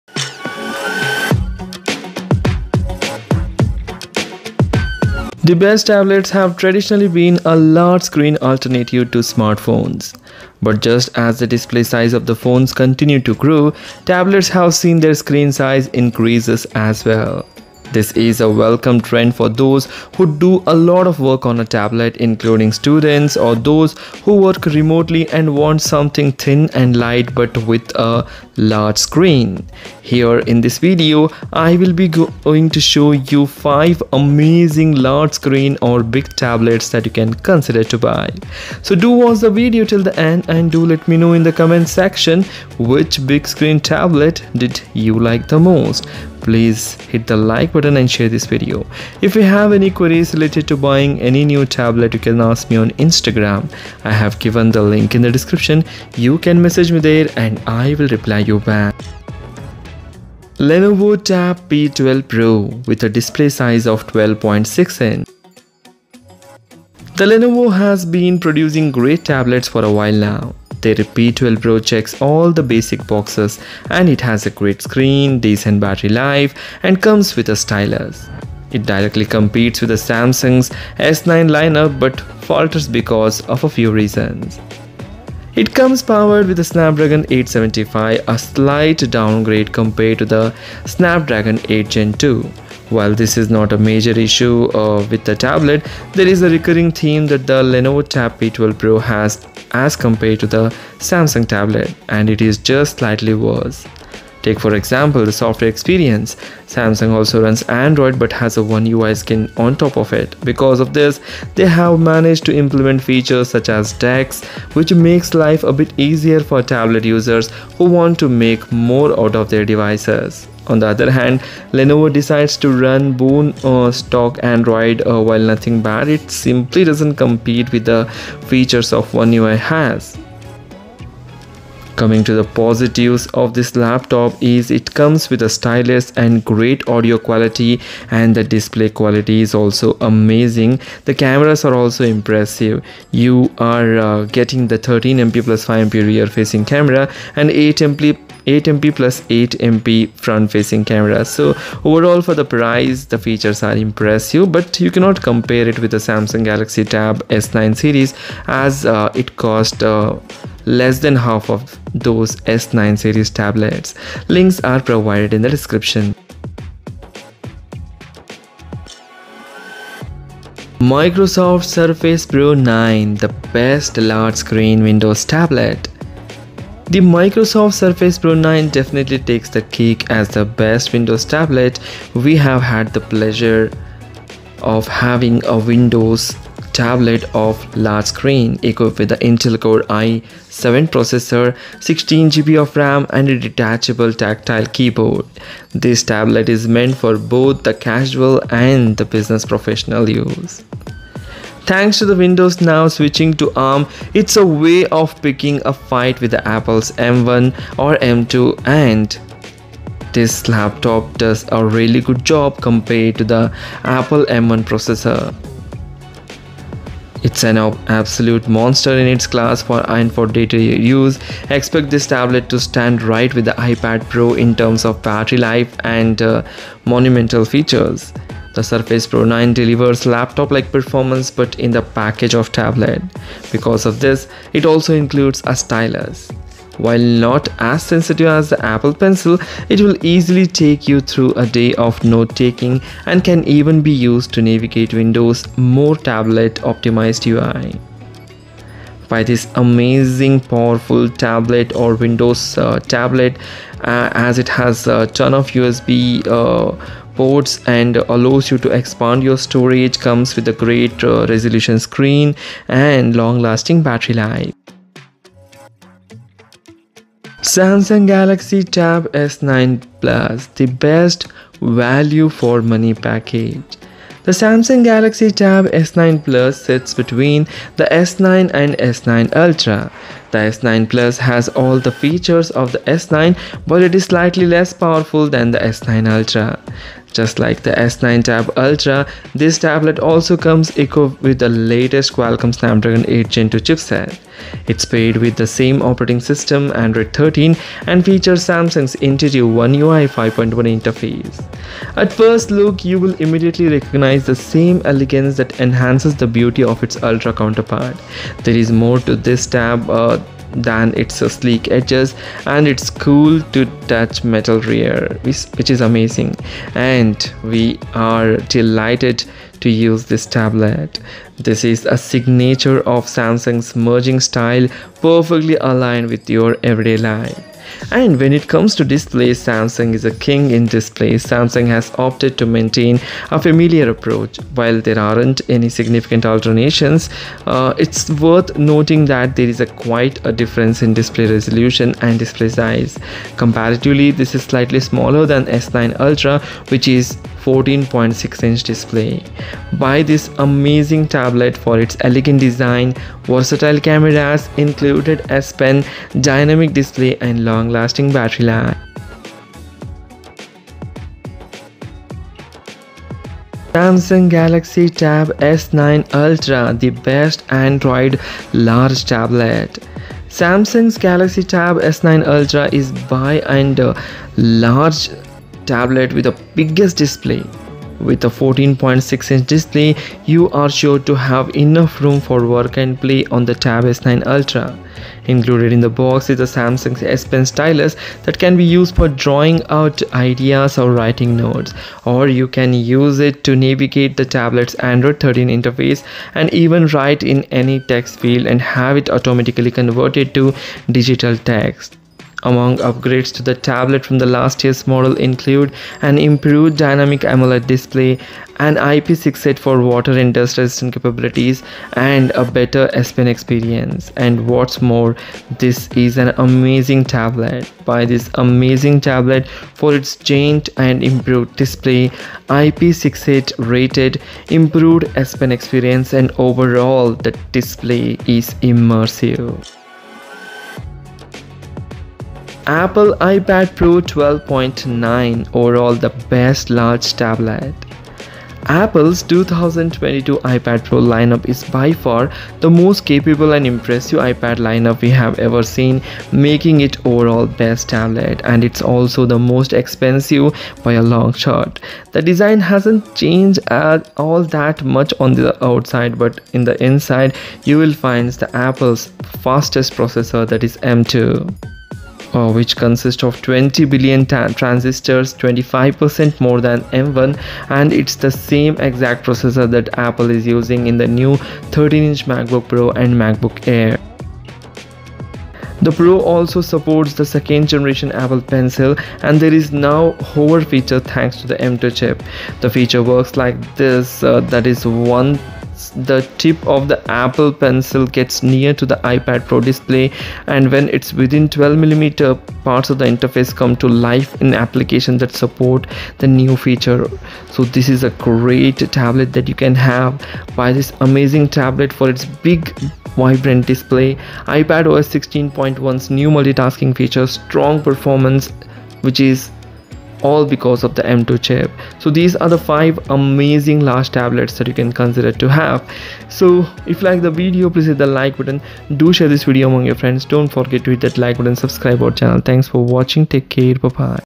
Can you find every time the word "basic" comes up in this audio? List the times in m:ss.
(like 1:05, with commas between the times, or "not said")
1:12.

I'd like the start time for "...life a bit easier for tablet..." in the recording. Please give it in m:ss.
1:55.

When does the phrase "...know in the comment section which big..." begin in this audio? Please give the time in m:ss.
0:41.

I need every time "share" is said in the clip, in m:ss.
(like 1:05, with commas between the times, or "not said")
0:48, 8:39.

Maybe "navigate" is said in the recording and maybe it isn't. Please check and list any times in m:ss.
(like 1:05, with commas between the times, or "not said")
4:04, 6:33.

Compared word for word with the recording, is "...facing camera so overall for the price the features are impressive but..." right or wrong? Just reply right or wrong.
right.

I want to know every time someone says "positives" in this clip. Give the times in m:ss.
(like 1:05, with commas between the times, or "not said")
2:12.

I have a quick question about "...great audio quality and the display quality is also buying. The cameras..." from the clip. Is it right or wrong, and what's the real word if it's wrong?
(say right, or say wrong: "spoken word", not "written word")
wrong: "amazing", not "buying".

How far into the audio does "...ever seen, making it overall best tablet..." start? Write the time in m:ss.
7:25.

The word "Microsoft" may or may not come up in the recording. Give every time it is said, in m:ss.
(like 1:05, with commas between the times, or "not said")
2:50, 2:56.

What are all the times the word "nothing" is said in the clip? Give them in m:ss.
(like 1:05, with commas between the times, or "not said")
2:05.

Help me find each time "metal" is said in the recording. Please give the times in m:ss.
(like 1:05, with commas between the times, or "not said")
5:14.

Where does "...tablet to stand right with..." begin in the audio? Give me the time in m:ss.
3:42.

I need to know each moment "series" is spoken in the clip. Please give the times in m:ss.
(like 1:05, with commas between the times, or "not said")
2:37, 2:42.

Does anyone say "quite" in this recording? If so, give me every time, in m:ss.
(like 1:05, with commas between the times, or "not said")
5:39.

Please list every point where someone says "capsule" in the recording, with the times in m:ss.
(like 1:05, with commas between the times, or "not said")
not said.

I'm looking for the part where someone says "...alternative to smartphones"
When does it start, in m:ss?
0:08.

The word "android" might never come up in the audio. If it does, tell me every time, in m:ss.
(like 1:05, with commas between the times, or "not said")
1:47, 2:04, 4:56, 6:07, 6:34.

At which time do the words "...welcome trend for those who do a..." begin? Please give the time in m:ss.
0:18.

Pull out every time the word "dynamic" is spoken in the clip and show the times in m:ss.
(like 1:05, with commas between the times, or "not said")
5:56, 6:46.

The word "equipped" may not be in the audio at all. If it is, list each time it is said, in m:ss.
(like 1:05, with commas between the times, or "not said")
3:08, 4:50.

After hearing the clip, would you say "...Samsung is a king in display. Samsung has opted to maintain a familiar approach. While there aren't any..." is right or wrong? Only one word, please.
right.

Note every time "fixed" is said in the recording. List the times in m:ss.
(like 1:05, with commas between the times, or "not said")
not said.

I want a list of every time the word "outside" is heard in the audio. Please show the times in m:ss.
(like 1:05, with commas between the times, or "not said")
7:35.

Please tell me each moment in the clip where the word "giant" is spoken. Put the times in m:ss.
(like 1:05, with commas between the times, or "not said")
7:00.